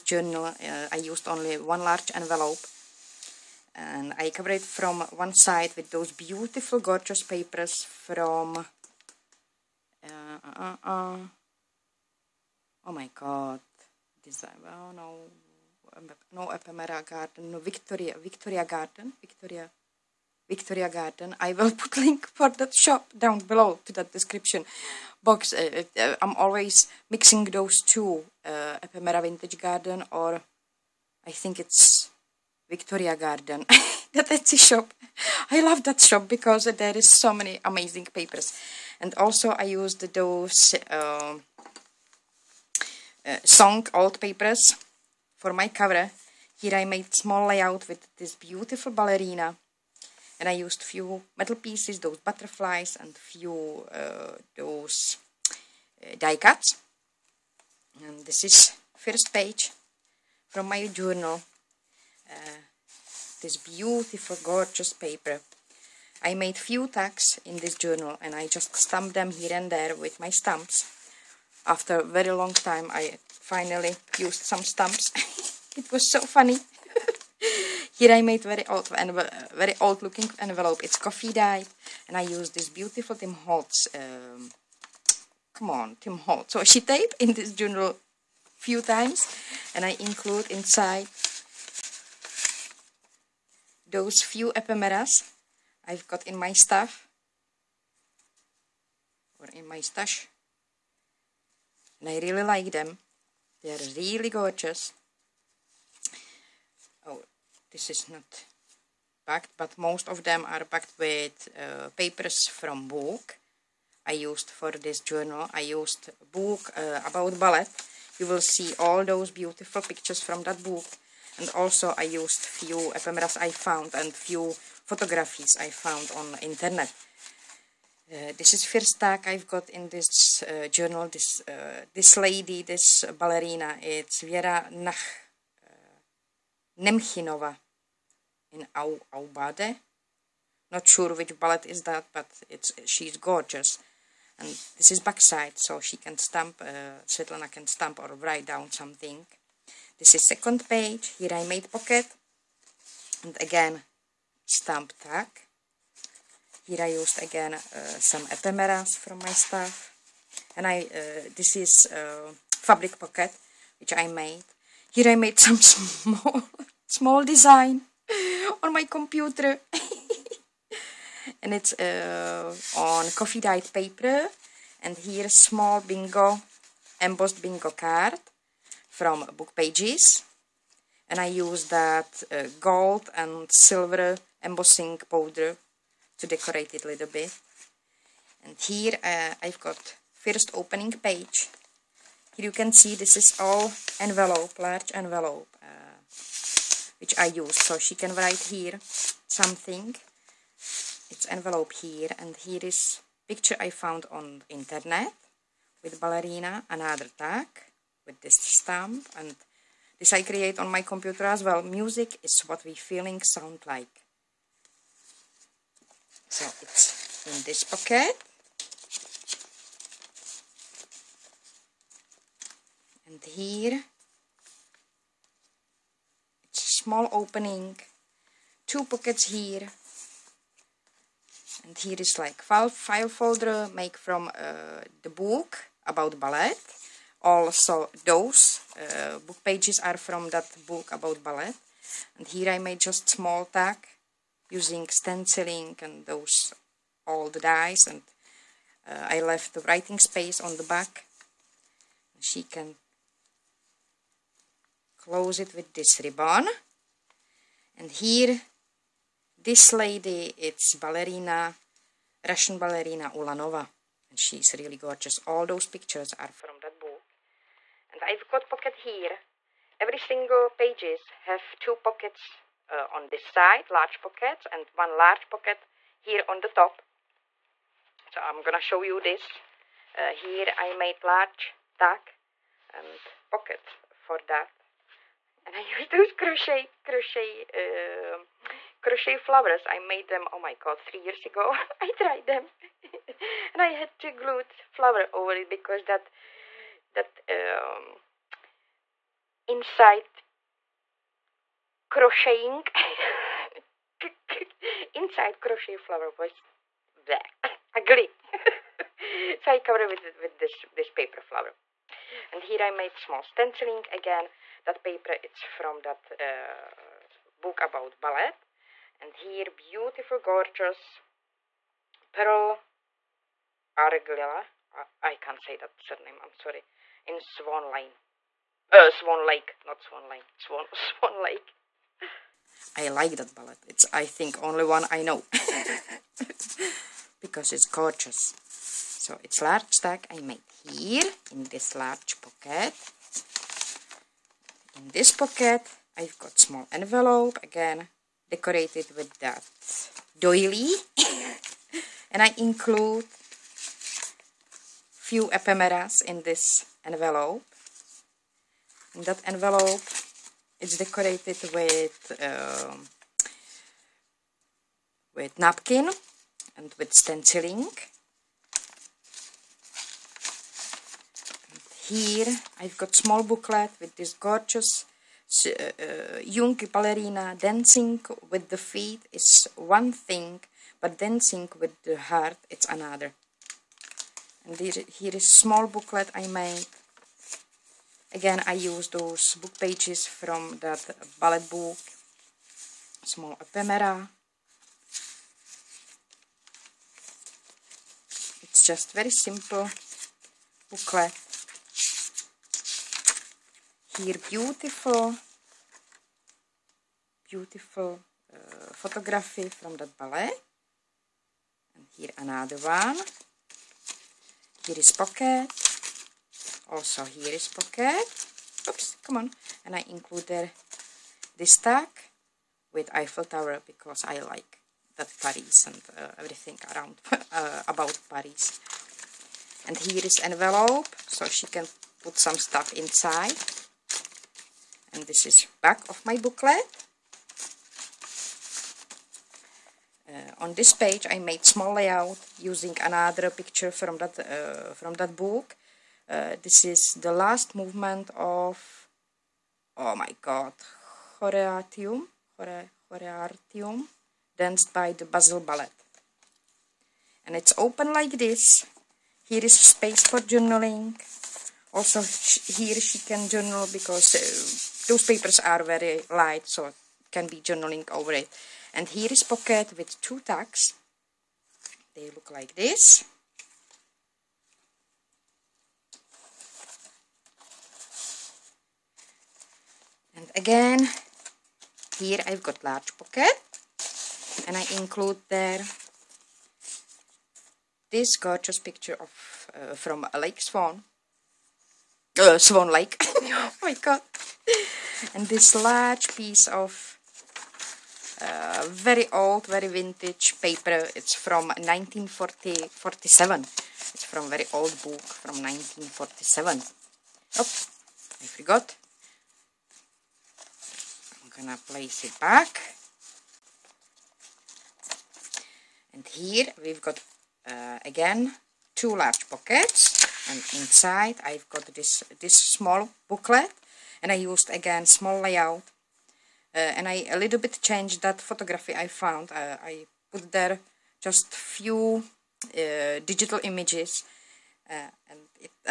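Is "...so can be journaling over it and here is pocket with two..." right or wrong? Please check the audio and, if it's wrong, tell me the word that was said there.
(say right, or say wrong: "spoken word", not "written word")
right.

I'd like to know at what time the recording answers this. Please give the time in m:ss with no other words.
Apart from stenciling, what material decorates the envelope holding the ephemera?
6:05.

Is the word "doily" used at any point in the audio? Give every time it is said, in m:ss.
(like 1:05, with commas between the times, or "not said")
5:50.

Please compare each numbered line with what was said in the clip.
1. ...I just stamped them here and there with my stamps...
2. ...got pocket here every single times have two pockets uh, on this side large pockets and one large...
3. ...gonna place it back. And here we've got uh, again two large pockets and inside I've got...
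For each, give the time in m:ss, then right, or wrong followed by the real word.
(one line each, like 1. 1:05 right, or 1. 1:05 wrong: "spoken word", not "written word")
1. 1:08 right
2. 4:28 wrong: "pages", not "times"
3. 8:31 right.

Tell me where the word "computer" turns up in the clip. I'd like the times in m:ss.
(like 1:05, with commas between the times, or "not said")
2:48, 3:30.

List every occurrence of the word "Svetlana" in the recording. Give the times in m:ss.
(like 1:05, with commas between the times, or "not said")
2:27.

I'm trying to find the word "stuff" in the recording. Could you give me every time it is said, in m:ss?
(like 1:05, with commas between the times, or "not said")
1:36, 2:39, 7:12.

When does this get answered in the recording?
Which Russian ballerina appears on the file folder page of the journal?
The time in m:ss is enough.
4:22.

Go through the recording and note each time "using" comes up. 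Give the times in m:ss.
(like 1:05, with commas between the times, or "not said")
4:04, 7:22.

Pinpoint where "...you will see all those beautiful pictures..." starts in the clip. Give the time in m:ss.
1:58.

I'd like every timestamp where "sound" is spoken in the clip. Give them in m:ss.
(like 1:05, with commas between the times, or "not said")
3:33.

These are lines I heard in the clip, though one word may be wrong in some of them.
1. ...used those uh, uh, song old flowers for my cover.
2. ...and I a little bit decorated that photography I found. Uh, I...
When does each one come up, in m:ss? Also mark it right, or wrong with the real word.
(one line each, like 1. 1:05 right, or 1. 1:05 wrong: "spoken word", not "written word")
1. 0:39 wrong: "papers", not "flowers"
2. 8:46 wrong: "changed", not "decorated".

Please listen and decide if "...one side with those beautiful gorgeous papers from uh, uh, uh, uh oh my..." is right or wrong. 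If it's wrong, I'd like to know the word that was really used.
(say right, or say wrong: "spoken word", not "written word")
right.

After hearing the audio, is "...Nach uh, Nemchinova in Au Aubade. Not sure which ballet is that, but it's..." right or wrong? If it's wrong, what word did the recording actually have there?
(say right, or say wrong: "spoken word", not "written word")
right.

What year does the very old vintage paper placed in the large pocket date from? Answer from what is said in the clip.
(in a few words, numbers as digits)
1947.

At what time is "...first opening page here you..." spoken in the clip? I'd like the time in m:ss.
3:10.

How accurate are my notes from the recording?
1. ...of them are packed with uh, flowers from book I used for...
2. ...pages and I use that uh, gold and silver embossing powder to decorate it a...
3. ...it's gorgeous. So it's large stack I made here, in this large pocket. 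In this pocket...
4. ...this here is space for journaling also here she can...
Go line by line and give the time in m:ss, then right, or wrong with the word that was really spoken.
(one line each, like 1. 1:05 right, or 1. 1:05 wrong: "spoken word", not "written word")
1. 1:50 wrong: "papers", not "flowers"
2. 2:59 right
3. 5:37 right
4. 7:38 right.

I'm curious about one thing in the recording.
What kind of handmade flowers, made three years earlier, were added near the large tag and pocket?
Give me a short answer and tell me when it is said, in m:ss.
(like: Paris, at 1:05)
crochet flowers, at 4:48.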